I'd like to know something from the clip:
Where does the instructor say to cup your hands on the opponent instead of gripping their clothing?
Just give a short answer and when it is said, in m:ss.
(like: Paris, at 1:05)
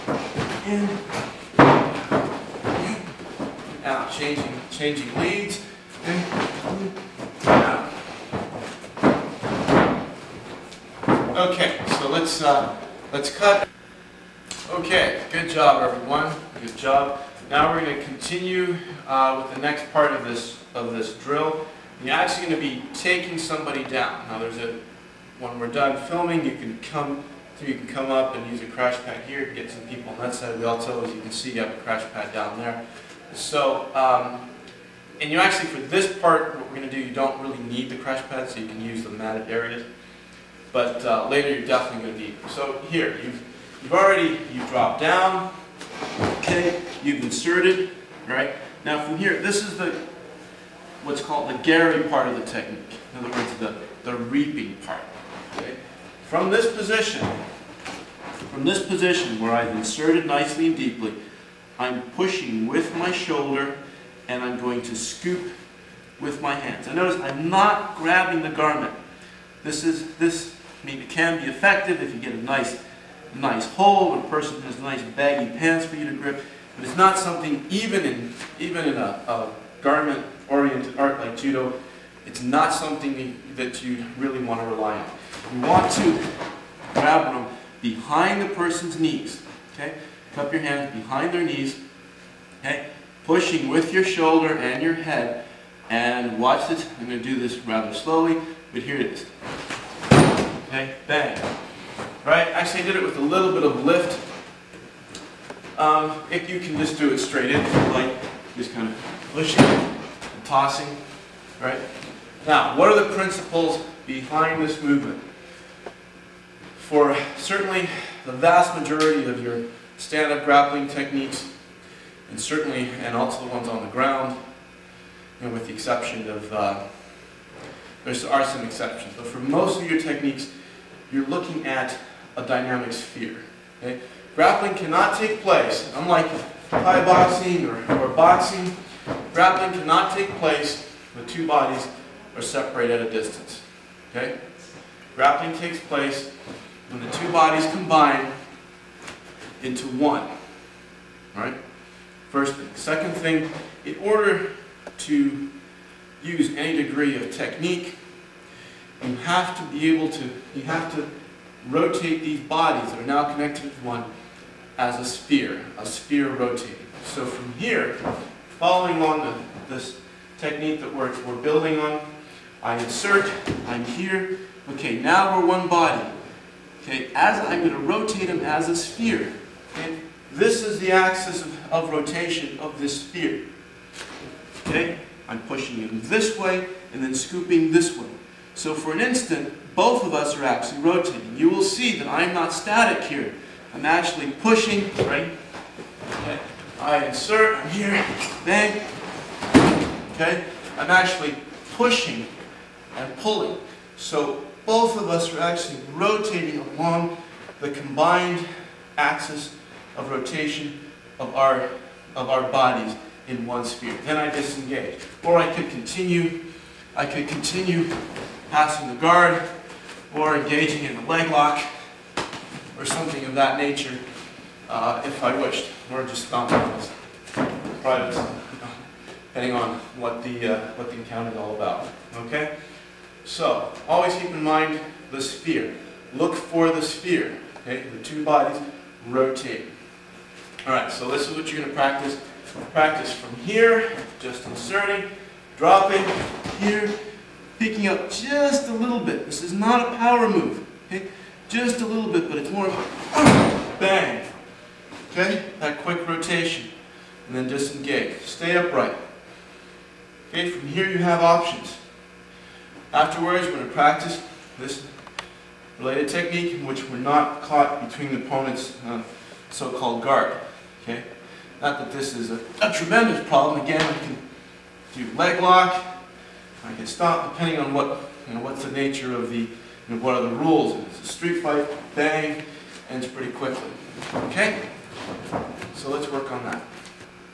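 behind their knees, at 1:30.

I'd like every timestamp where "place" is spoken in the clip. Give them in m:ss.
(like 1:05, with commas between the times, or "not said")
2:15, 2:20, 2:25.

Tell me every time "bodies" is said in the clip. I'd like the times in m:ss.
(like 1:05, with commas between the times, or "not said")
2:21, 2:27, 2:42, 3:32, 3:58.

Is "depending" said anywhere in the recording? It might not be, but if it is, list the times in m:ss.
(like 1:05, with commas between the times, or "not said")
3:49, 4:37.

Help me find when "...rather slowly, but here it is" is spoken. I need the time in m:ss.
1:37.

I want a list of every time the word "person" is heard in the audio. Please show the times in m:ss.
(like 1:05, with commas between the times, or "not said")
1:14, 1:28.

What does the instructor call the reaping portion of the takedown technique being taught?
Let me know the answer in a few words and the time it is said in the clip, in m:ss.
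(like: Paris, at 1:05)
gari, at 0:51.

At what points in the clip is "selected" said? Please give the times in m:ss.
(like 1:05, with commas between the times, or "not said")
not said.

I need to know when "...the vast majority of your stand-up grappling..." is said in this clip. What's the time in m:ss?
1:58.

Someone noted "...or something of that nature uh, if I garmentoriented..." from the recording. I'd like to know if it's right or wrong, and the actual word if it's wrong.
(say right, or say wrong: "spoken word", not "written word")
wrong: "wished", not "garmentoriented".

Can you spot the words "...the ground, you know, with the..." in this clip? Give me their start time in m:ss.
2:03.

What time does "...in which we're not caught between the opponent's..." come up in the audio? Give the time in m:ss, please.
4:26.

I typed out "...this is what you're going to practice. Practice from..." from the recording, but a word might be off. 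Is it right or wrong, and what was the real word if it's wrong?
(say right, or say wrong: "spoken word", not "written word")
right.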